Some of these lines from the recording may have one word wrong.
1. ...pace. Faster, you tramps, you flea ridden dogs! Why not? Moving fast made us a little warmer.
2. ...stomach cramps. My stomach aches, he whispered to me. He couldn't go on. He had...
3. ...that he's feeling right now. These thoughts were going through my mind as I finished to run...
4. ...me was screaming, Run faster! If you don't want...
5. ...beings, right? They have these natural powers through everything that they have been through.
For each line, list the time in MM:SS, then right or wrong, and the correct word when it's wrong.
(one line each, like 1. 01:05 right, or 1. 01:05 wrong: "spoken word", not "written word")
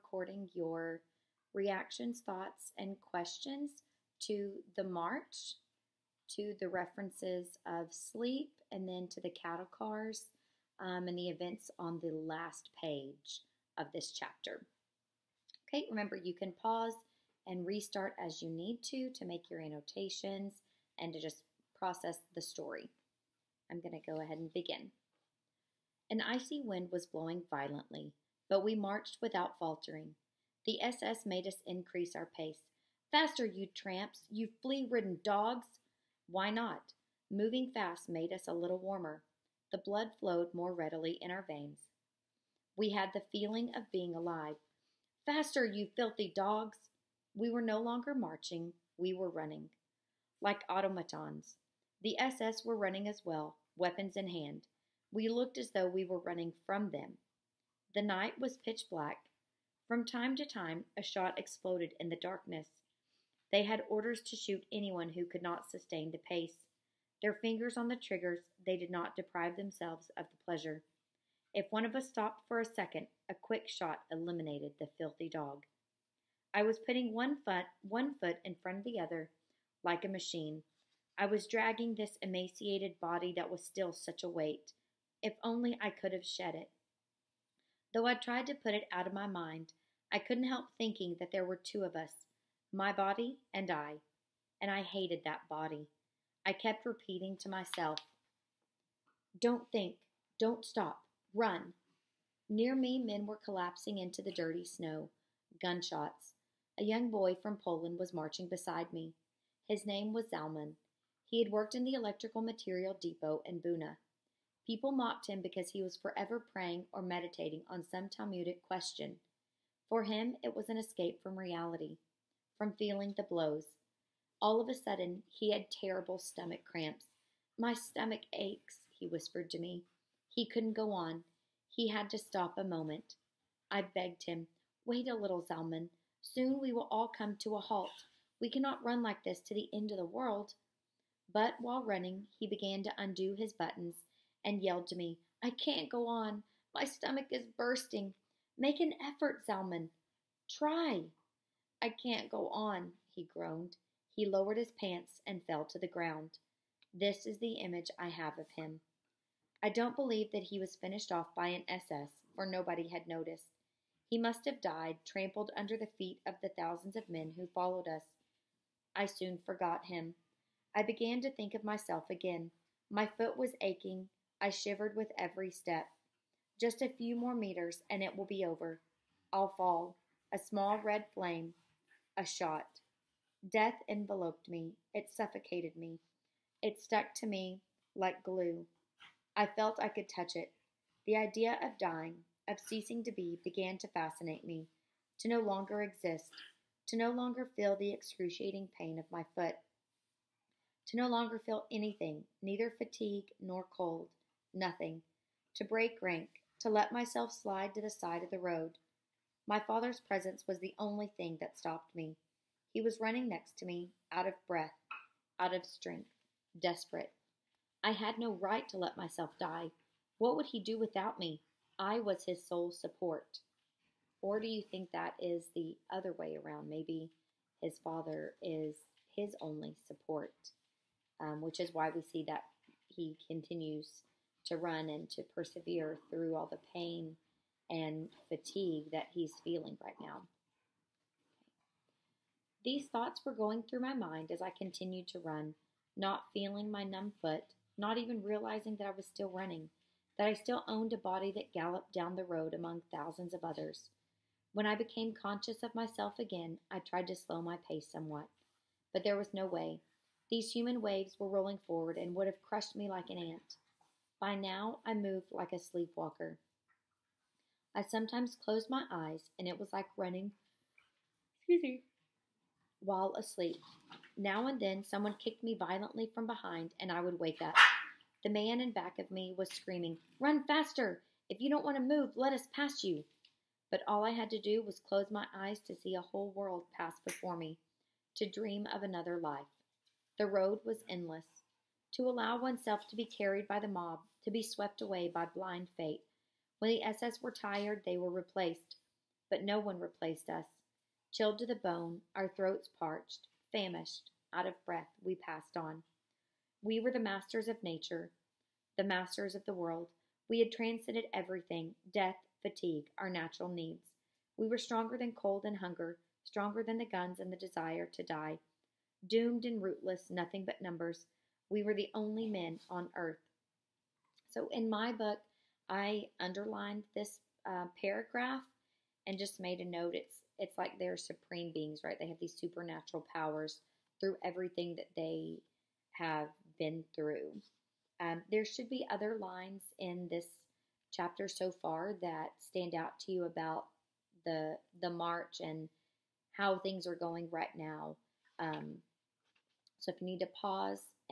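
1. 00:32 right
2. 02:06 right
3. 03:58 wrong: "continued", not "finished"
4. 04:39 right
5. 05:31 wrong: "supernatural", not "natural".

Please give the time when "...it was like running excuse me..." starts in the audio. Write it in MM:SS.
04:29.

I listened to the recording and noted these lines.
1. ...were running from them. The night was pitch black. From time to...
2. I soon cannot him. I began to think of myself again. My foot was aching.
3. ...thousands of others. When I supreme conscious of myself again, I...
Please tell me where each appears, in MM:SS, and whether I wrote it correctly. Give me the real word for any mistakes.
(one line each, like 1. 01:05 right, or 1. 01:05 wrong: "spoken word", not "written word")
1. 00:56 right
2. 02:48 wrong: "forgot", not "cannot"
3. 04:12 wrong: "became", not "supreme".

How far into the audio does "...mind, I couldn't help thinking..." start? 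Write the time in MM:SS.
01:29.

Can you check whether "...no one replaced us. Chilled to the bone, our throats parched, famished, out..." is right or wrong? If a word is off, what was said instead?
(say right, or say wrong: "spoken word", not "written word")
right.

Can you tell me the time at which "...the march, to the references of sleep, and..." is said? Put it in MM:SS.
00:04.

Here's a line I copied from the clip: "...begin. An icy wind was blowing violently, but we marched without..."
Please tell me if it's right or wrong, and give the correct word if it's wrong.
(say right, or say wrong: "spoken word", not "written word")
right.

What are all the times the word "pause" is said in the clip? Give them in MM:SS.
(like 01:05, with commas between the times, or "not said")
00:16, 05:50.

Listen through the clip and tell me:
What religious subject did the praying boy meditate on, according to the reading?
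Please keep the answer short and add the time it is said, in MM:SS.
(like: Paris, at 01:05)
Talmudic question, at 01:58.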